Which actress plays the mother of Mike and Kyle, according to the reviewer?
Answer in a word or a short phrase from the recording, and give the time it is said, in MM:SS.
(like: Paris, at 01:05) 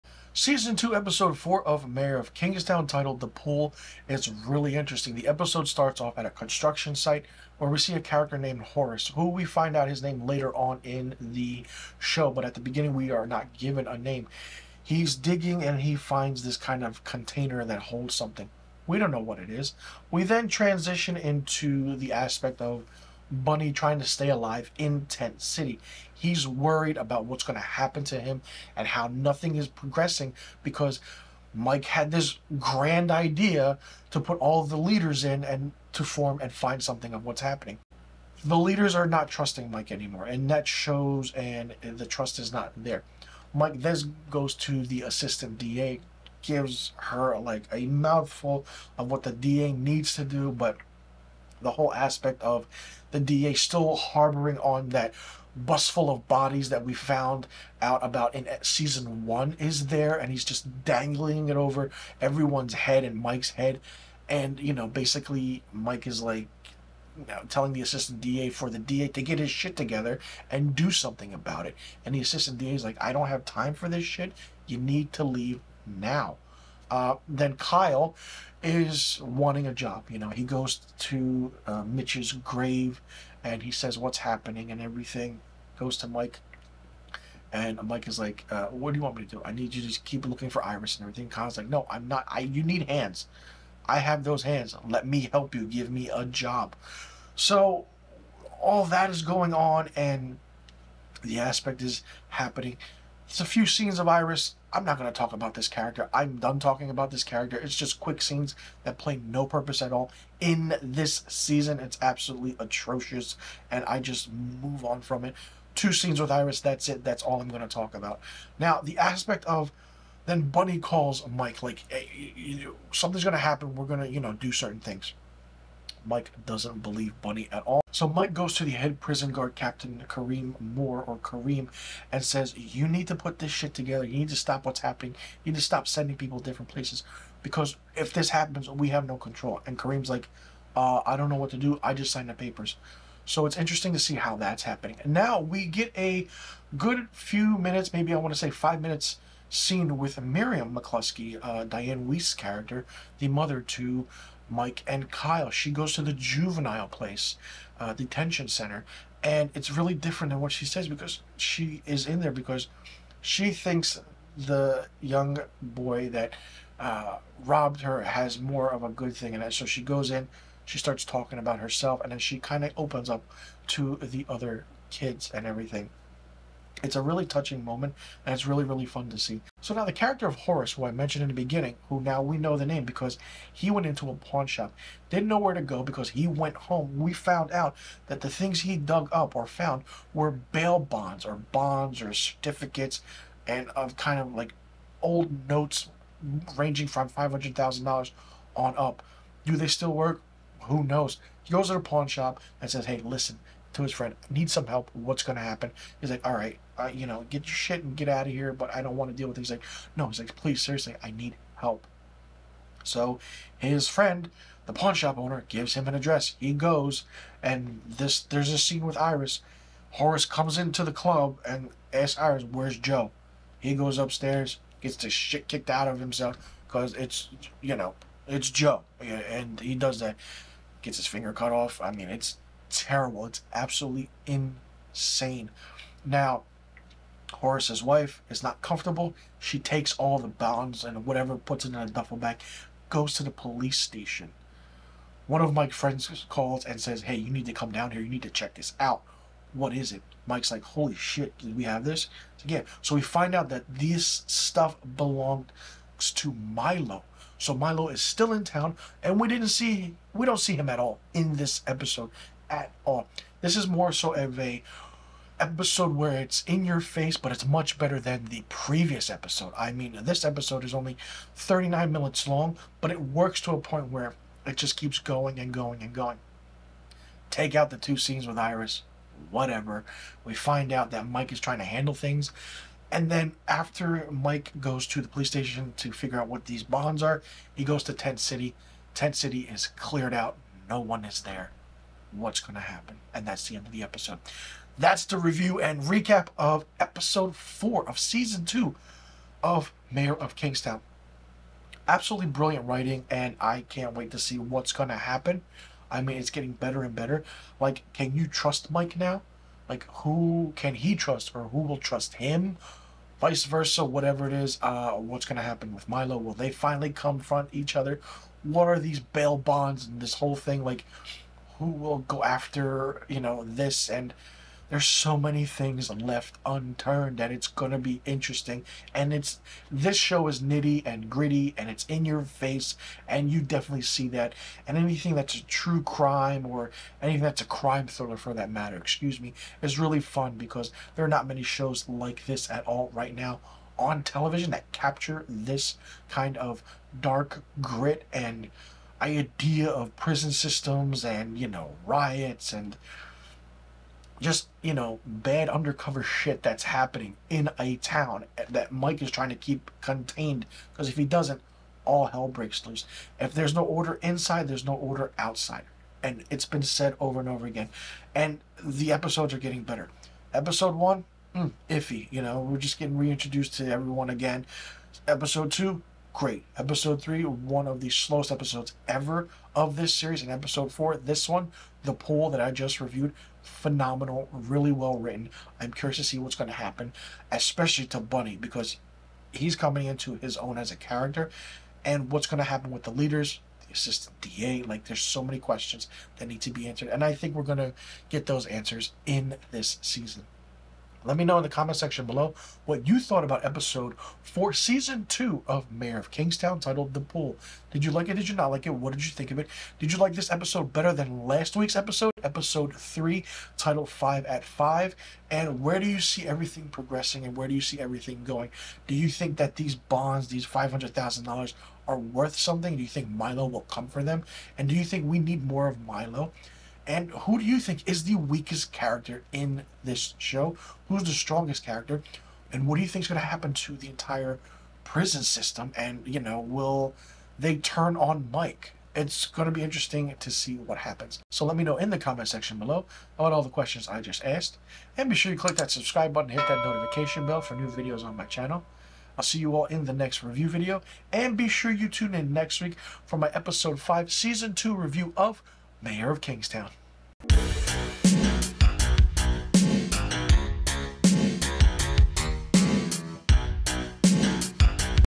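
Dianne Wiest, at 02:31.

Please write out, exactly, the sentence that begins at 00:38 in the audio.
The leaders are not trusting Mike anymore, and that shows, and the trust is not there.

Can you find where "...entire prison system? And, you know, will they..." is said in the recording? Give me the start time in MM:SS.
07:13.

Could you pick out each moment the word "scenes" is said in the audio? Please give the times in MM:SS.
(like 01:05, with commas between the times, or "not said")
01:43, 01:48, 01:55, 02:29, 03:38, 04:37.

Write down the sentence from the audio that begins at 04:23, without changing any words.
This is more so of a episode where it's in your face, but it's much better than the previous episode.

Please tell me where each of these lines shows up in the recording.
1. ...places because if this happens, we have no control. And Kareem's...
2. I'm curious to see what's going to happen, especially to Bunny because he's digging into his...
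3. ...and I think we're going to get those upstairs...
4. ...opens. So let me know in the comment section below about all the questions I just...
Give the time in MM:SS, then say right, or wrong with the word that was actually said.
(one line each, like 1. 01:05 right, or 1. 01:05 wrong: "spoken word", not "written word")
1. 02:16 right
2. 06:25 wrong: "coming", not "digging"
3. 06:36 wrong: "answers", not "upstairs"
4. 07:20 wrong: "happens", not "opens".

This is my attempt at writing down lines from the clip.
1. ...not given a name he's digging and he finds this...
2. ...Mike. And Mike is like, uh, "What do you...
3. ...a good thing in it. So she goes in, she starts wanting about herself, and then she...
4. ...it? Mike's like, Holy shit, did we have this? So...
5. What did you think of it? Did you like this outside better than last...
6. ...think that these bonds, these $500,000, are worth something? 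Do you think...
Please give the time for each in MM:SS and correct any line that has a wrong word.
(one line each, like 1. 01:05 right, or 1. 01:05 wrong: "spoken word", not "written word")
1. 00:13 right
2. 01:26 right
3. 02:48 wrong: "talking", not "wanting"
4. 04:09 right
5. 06:48 wrong: "episode", not "outside"
6. 06:59 right.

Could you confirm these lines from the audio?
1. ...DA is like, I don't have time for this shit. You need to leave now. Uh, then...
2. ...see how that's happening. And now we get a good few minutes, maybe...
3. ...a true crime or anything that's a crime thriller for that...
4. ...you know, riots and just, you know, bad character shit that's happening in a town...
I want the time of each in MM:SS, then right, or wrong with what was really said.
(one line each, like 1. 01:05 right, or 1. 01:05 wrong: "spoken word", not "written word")
1. 01:12 right
2. 02:23 right
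3. 05:35 right
4. 05:51 wrong: "undercover", not "character".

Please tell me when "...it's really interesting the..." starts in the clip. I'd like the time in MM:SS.
00:04.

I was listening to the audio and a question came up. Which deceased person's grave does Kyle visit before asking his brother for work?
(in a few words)
Mitch.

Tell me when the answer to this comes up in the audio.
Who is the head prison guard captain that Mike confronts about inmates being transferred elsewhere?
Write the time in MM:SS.
02:10.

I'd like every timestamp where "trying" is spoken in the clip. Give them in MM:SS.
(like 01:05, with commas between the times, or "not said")
00:23, 04:41, 05:59.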